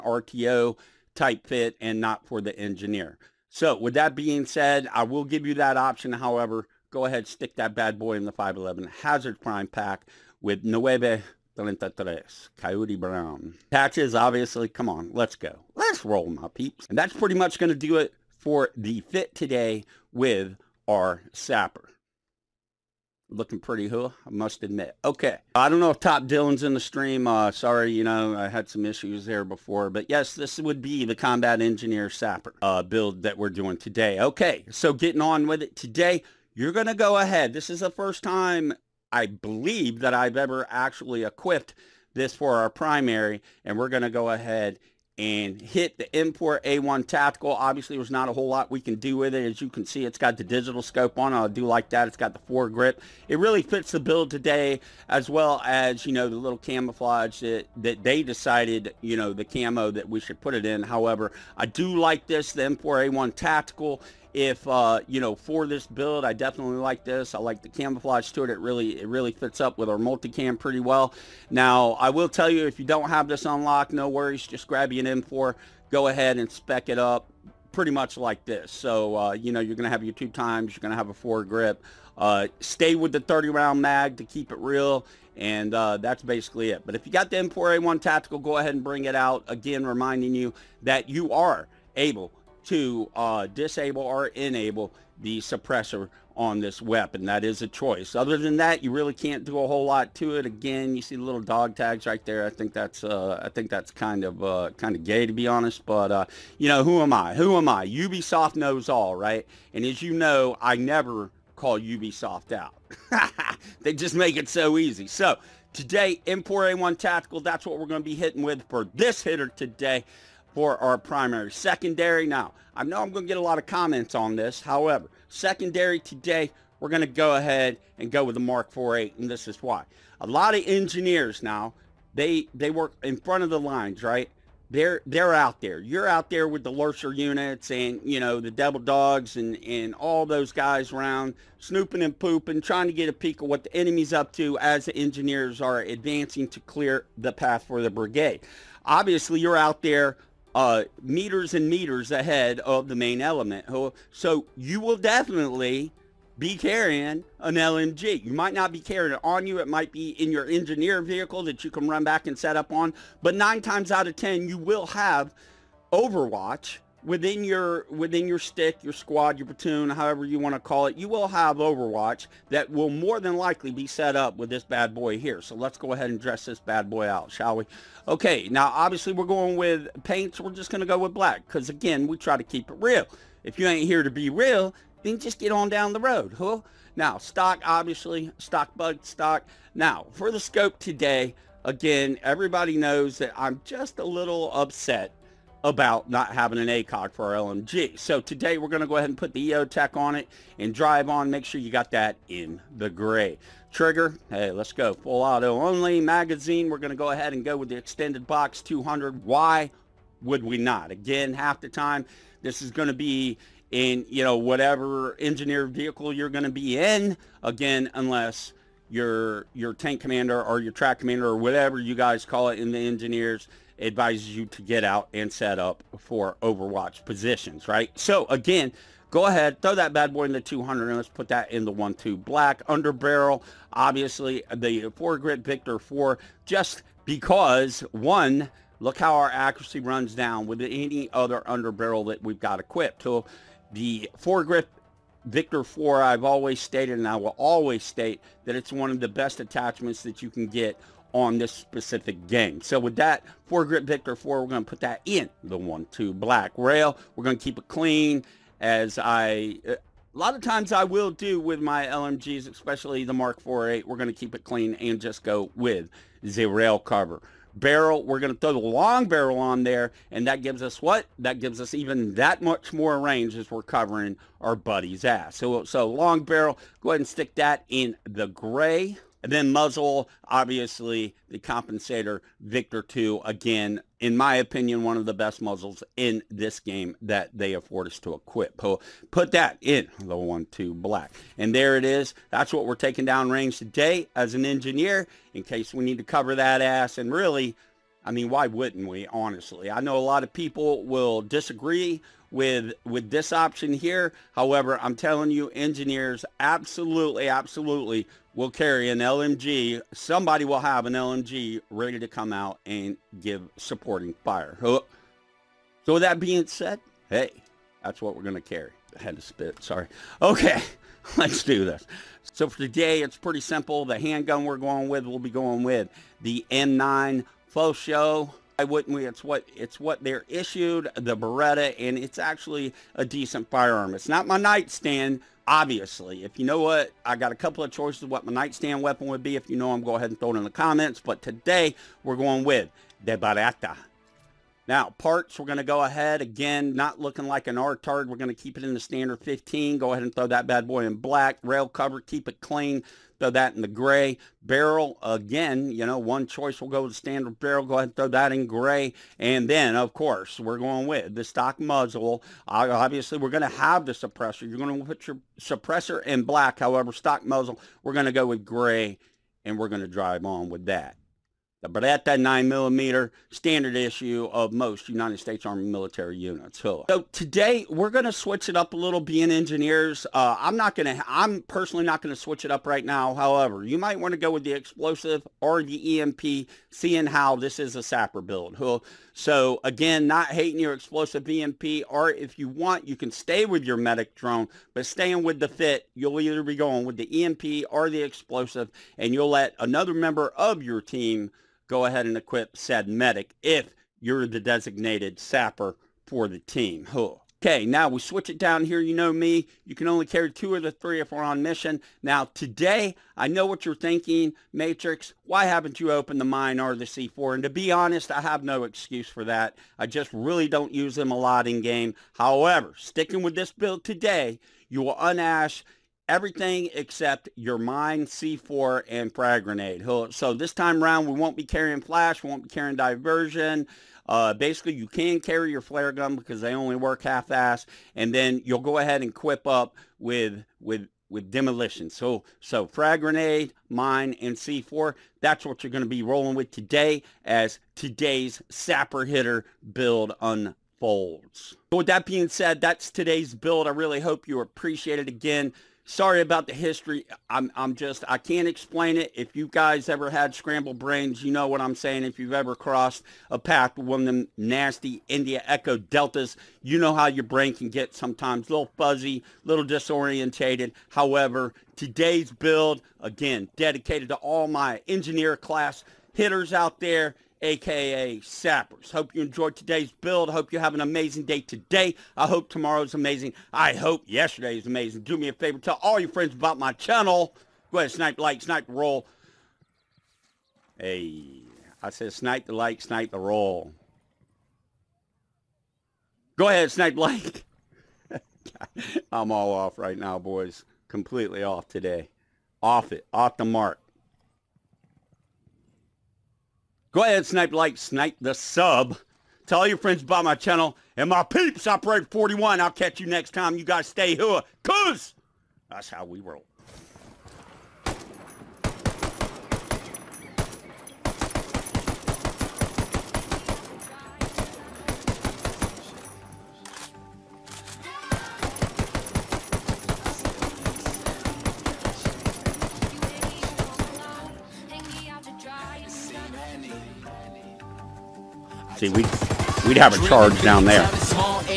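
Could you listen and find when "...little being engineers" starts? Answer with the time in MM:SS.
06:18.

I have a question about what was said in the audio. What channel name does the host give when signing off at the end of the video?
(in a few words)
Operator 41.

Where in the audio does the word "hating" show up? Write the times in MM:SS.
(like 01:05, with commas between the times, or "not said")
06:30.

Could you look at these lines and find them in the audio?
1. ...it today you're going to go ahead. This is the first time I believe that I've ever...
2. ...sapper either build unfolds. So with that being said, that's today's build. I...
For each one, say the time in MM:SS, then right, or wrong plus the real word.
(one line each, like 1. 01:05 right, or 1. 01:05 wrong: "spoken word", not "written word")
1. 00:35 right
2. 07:28 wrong: "hitter", not "either".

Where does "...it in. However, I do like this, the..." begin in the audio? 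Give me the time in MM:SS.
01:00.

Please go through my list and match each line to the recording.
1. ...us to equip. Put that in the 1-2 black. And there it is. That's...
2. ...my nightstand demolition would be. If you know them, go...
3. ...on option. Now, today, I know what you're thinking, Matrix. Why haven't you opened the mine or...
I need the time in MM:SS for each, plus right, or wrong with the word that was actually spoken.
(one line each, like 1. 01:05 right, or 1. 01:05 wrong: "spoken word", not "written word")
1. 04:47 right
2. 05:38 wrong: "weapon", not "demolition"
3. 06:51 wrong: "mission", not "option".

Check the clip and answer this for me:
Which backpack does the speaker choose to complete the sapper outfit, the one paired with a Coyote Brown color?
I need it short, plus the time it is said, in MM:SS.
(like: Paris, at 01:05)
5.11 Hazard Prime Pack, at 00:08.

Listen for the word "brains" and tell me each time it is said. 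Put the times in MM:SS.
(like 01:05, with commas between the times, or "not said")
07:40, 07:47.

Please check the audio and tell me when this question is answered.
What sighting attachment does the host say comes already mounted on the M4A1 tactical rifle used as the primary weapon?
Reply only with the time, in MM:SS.
00:50.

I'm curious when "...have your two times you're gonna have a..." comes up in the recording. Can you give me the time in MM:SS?
01:19.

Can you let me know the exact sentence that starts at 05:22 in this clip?
So for today, it's pretty simple.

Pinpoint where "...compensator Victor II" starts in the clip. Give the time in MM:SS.
04:41.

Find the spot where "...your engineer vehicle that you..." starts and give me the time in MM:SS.
02:40.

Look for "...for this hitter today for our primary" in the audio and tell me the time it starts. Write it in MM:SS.
01:58.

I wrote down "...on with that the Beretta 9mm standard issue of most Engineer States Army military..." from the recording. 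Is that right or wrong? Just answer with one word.
wrong.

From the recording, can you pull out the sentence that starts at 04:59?
I know a lot of people will disagree with with this option here.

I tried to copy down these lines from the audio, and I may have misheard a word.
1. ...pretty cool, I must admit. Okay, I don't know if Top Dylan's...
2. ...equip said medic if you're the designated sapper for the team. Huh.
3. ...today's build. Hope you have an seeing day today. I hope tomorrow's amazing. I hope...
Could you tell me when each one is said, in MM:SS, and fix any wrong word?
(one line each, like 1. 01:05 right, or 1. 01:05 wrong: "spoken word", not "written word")
1. 00:23 right
2. 06:42 right
3. 07:59 wrong: "amazing", not "seeing".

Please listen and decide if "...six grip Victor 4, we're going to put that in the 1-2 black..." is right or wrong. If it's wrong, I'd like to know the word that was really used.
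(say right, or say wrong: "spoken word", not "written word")
wrong: "four", not "six".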